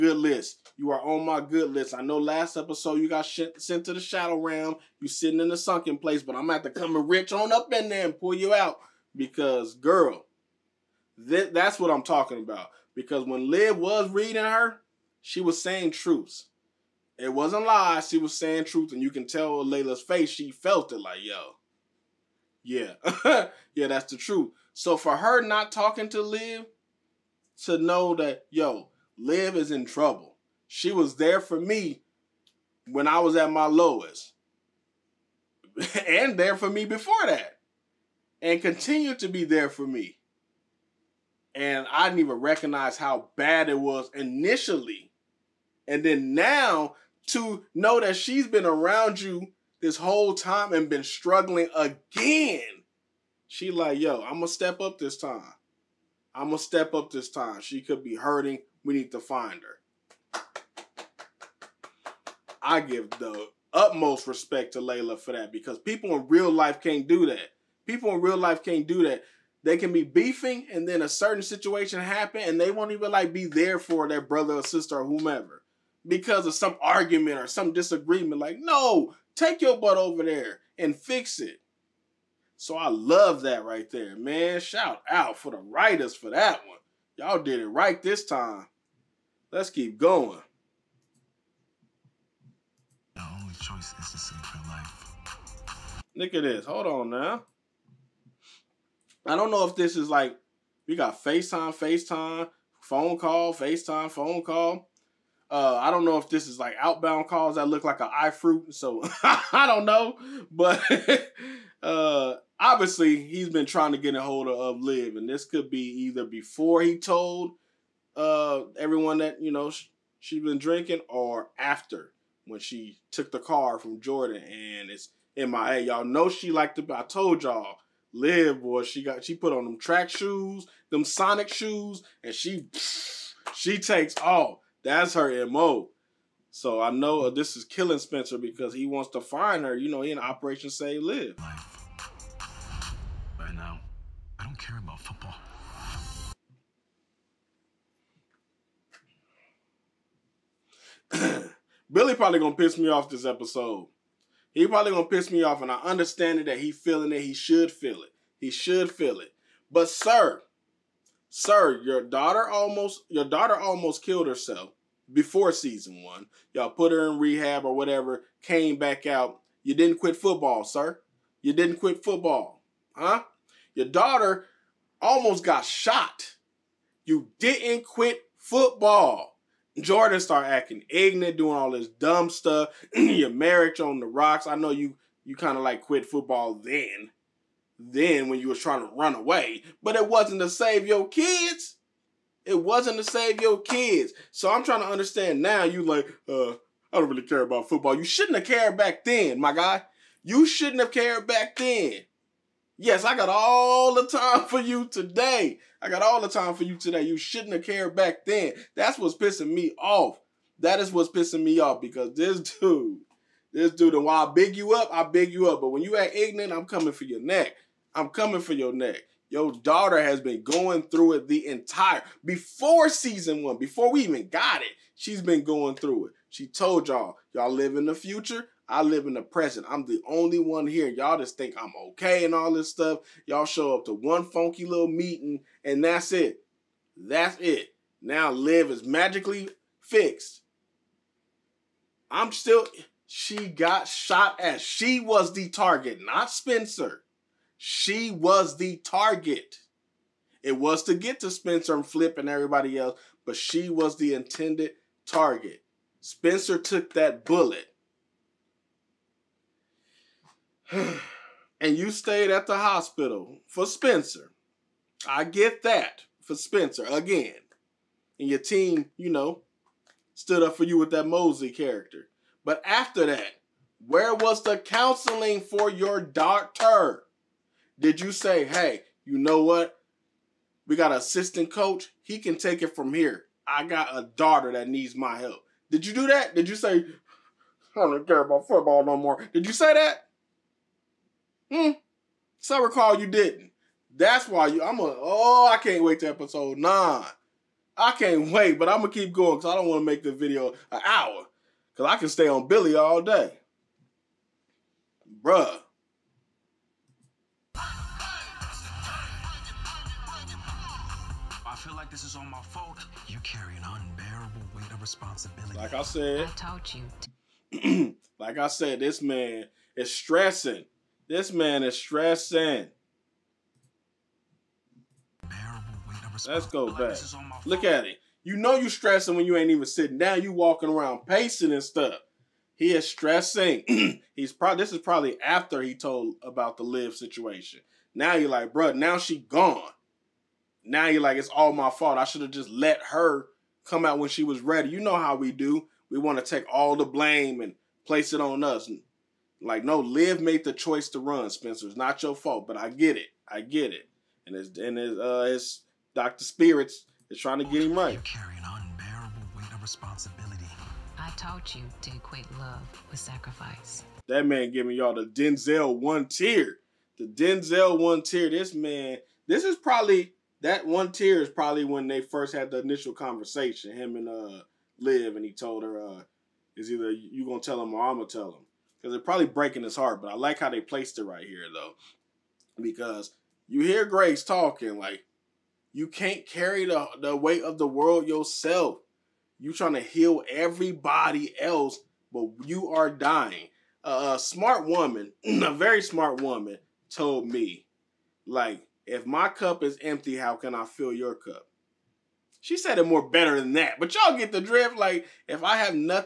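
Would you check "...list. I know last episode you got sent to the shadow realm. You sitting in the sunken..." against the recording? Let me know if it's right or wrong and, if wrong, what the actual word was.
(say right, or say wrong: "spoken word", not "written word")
right.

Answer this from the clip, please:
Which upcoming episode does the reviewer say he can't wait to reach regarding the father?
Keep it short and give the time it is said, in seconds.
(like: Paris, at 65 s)
9, at 296 s.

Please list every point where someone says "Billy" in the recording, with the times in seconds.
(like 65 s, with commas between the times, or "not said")
151 s, 302 s.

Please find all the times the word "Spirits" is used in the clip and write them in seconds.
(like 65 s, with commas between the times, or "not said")
356 s.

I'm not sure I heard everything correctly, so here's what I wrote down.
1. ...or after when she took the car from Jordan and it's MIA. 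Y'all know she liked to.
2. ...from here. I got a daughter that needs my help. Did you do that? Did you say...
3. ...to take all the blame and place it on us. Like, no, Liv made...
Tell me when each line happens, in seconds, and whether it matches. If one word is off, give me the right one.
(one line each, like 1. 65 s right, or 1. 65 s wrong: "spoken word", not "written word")
1. 121 s right
2. 282 s right
3. 346 s right.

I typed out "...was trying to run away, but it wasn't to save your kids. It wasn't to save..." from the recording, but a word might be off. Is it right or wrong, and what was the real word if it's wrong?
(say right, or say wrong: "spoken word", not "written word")
right.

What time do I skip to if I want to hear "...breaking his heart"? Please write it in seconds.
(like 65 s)
379 s.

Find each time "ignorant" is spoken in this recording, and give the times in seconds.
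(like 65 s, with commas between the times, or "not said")
180 s, 216 s.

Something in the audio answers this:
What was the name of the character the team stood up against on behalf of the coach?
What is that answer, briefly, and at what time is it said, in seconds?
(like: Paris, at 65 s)
Mosey, at 271 s.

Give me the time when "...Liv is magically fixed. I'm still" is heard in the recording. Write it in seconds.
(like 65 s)
238 s.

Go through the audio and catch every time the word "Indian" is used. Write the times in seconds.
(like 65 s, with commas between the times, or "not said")
not said.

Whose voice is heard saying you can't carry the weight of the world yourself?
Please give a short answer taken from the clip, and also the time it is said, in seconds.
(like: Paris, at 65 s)
Grace, at 383 s.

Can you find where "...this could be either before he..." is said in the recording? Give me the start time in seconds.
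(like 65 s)
115 s.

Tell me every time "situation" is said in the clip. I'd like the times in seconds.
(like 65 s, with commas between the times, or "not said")
71 s, 336 s.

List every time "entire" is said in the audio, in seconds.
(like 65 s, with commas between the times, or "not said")
221 s.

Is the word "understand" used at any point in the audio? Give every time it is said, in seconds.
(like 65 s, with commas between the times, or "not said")
155 s, 194 s.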